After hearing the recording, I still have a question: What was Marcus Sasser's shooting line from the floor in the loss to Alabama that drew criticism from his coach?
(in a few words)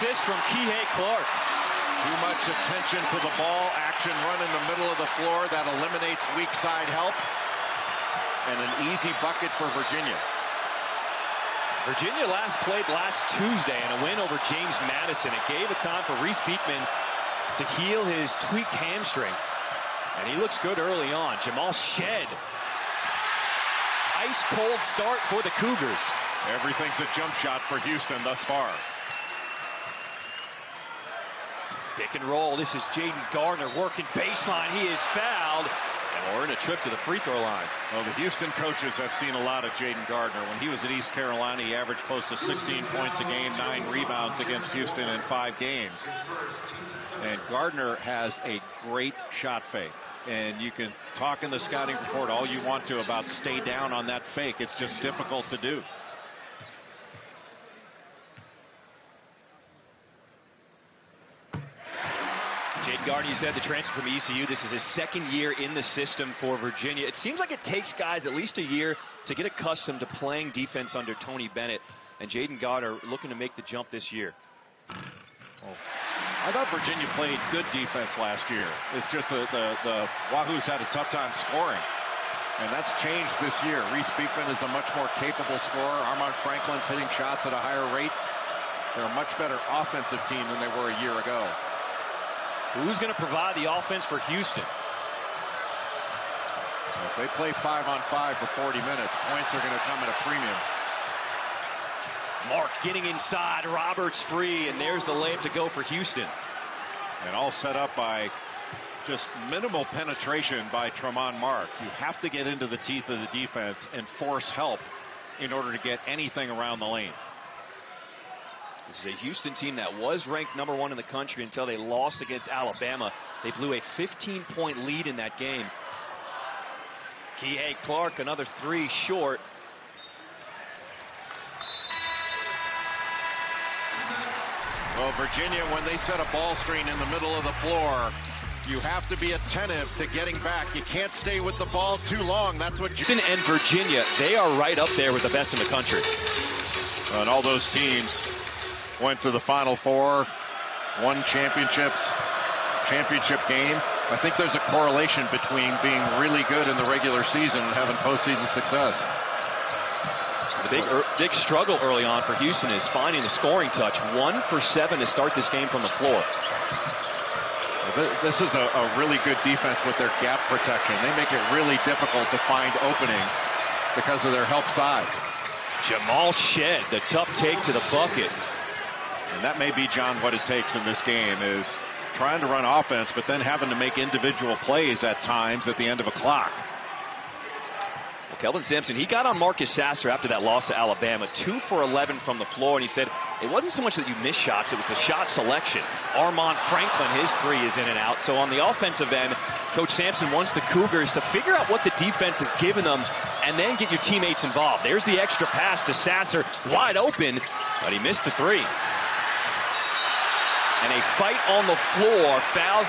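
2 for 11.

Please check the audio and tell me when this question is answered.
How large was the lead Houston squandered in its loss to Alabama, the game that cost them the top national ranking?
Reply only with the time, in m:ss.
2:03.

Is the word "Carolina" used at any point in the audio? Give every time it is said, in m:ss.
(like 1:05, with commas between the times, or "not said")
0:41.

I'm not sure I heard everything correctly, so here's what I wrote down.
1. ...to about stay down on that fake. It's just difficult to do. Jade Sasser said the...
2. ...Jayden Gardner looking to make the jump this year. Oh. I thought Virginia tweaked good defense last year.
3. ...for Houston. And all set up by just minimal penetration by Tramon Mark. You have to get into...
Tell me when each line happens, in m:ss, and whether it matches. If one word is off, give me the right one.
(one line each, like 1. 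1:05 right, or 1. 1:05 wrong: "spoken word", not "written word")
1. 0:52 wrong: "Gardner", not "Sasser"
2. 1:12 wrong: "played", not "tweaked"
3. 1:45 right.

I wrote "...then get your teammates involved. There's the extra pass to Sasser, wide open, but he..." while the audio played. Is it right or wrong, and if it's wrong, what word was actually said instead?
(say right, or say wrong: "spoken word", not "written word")
right.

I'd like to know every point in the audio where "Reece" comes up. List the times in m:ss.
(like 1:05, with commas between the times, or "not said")
0:16, 1:23.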